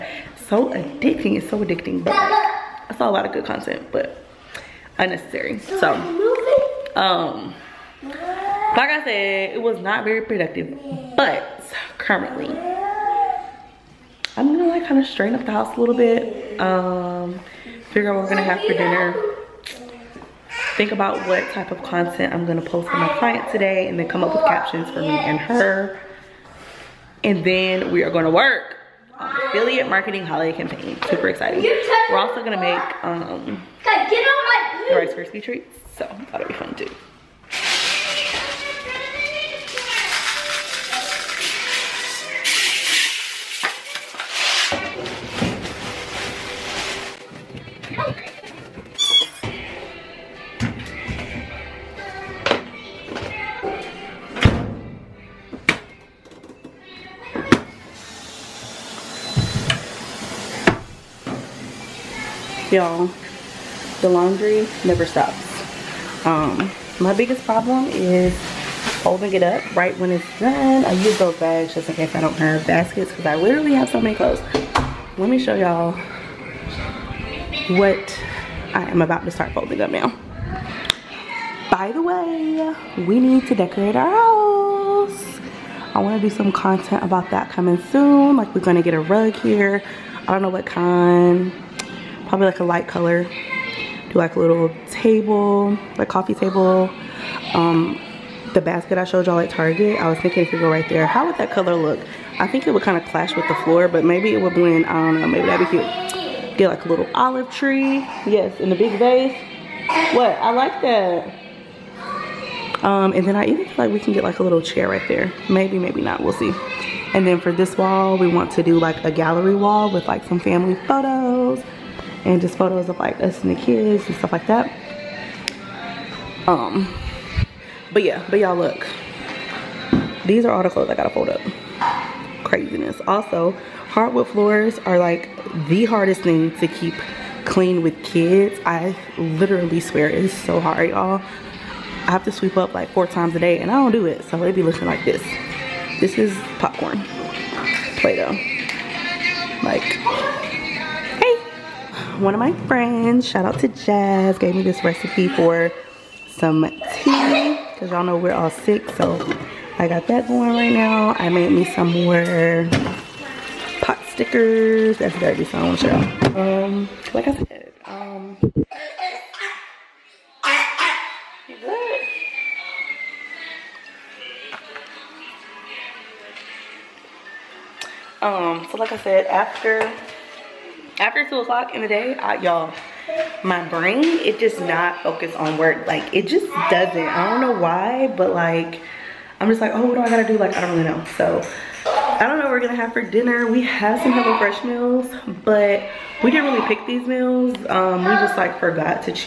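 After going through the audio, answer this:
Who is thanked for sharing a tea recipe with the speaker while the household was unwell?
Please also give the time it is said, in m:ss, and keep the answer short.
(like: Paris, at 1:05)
Jazz, at 2:33.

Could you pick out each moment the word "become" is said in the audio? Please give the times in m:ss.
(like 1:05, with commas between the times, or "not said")
not said.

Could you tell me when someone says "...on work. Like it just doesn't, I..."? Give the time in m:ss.
3:05.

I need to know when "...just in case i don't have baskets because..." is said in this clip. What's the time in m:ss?
1:11.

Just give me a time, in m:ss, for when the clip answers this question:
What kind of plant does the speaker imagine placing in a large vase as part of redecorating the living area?
1:47.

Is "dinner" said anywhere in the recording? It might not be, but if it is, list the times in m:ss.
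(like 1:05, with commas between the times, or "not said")
0:18, 3:12.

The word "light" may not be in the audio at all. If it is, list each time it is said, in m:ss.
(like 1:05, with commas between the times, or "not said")
1:32.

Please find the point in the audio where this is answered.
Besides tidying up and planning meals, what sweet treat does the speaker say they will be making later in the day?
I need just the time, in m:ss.
0:34.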